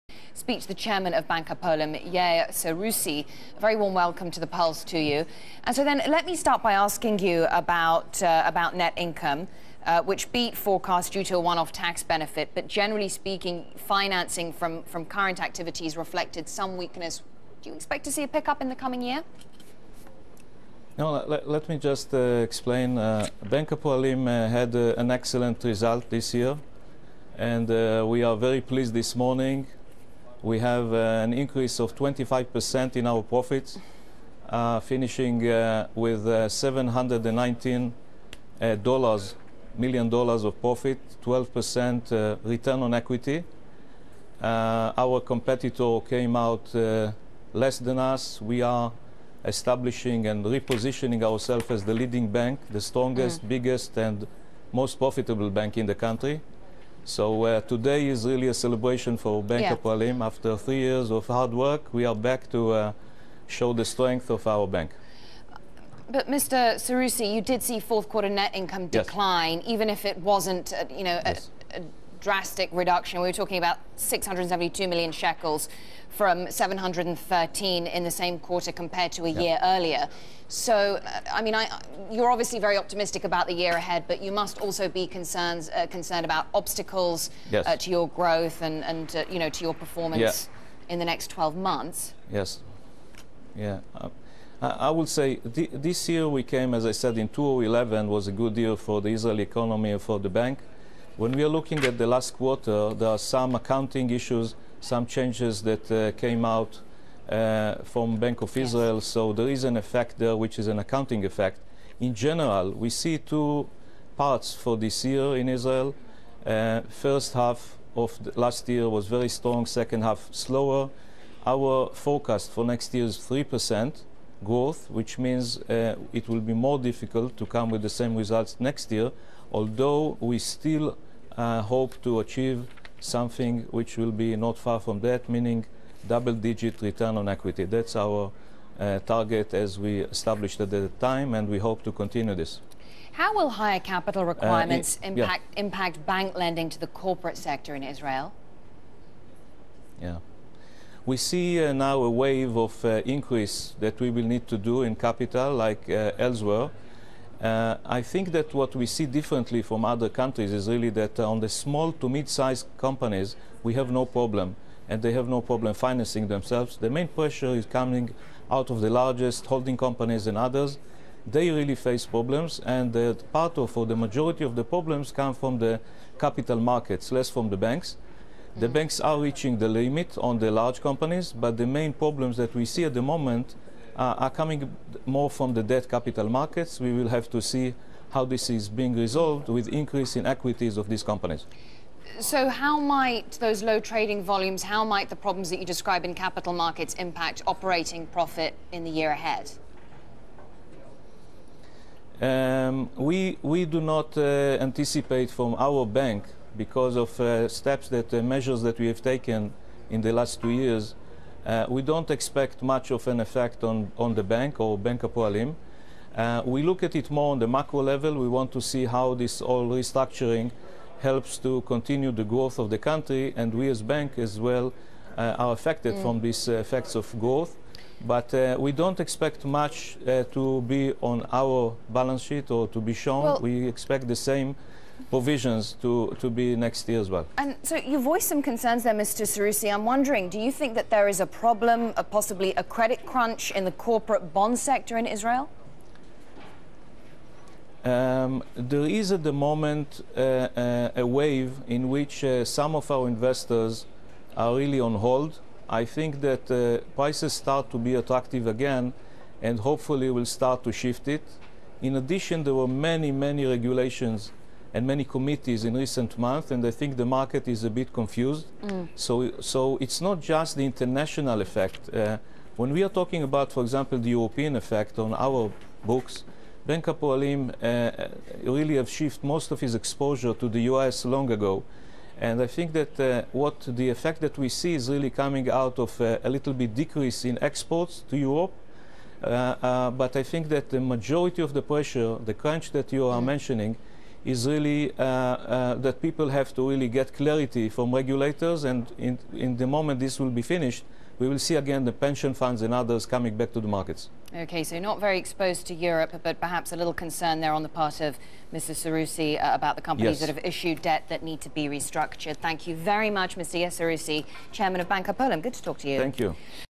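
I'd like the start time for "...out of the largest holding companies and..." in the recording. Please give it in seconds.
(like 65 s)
168 s.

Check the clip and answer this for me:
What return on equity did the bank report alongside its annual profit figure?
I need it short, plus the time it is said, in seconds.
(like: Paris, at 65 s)
12%, at 41 s.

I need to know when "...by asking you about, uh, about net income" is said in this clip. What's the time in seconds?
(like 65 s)
6 s.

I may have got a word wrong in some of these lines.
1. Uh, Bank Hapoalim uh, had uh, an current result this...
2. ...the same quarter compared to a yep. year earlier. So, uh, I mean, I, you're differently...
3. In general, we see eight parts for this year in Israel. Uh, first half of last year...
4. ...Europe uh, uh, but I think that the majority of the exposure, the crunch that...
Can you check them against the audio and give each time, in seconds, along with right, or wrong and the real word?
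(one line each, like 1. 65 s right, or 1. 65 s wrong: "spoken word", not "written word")
1. 22 s wrong: "excellent", not "current"
2. 78 s wrong: "obviously", not "differently"
3. 111 s wrong: "two", not "eight"
4. 288 s wrong: "pressure", not "exposure".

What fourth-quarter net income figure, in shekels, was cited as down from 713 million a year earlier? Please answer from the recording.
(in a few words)
672 million shekels.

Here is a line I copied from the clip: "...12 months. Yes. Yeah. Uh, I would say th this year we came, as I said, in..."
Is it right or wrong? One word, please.
right.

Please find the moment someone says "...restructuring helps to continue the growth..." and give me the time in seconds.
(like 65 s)
219 s.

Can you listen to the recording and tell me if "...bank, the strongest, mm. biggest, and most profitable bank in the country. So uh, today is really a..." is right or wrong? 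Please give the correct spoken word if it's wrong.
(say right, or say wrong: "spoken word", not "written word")
right.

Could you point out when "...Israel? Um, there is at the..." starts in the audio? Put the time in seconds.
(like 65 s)
245 s.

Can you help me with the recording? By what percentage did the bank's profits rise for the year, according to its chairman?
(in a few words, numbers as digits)
25%.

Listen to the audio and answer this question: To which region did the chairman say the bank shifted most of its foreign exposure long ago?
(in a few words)
the US.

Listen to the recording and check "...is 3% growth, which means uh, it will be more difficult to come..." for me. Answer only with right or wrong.
right.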